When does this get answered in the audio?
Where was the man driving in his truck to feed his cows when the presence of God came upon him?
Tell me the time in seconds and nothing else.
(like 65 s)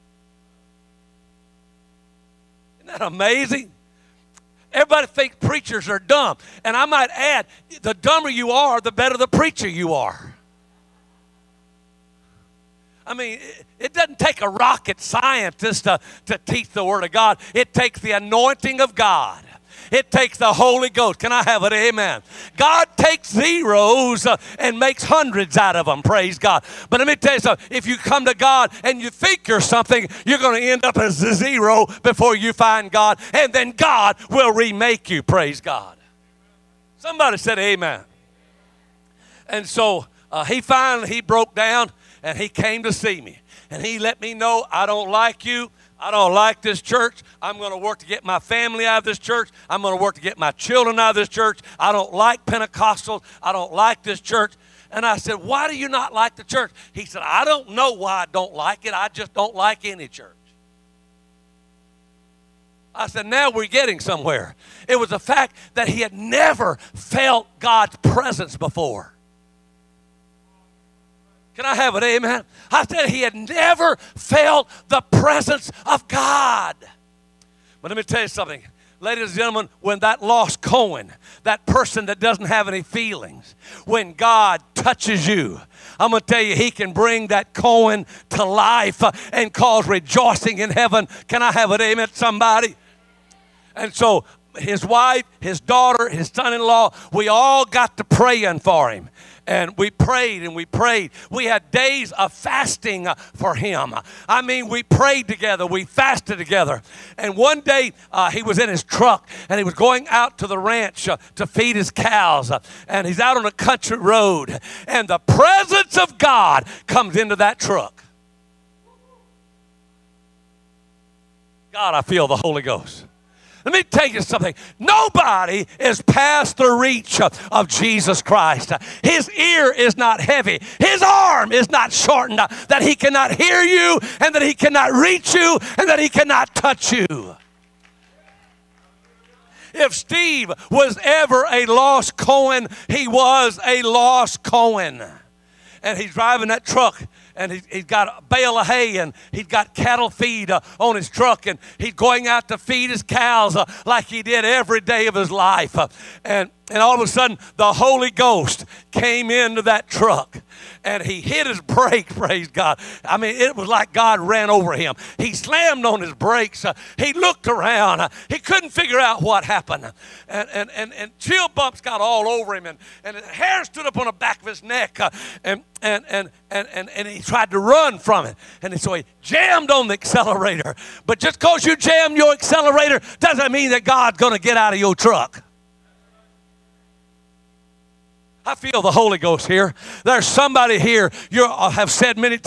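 110 s.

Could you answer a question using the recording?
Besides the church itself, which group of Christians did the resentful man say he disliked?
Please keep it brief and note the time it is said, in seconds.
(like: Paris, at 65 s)
Pentecostals, at 52 s.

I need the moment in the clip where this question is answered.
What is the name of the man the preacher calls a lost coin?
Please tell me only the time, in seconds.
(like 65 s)
139 s.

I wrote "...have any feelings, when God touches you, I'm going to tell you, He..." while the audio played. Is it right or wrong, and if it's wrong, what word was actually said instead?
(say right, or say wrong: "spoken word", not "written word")
right.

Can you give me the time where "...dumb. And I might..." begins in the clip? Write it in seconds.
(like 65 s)
5 s.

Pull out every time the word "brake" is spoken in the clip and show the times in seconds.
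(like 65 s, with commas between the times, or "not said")
161 s, 166 s.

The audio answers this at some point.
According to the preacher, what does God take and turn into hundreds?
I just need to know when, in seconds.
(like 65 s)
23 s.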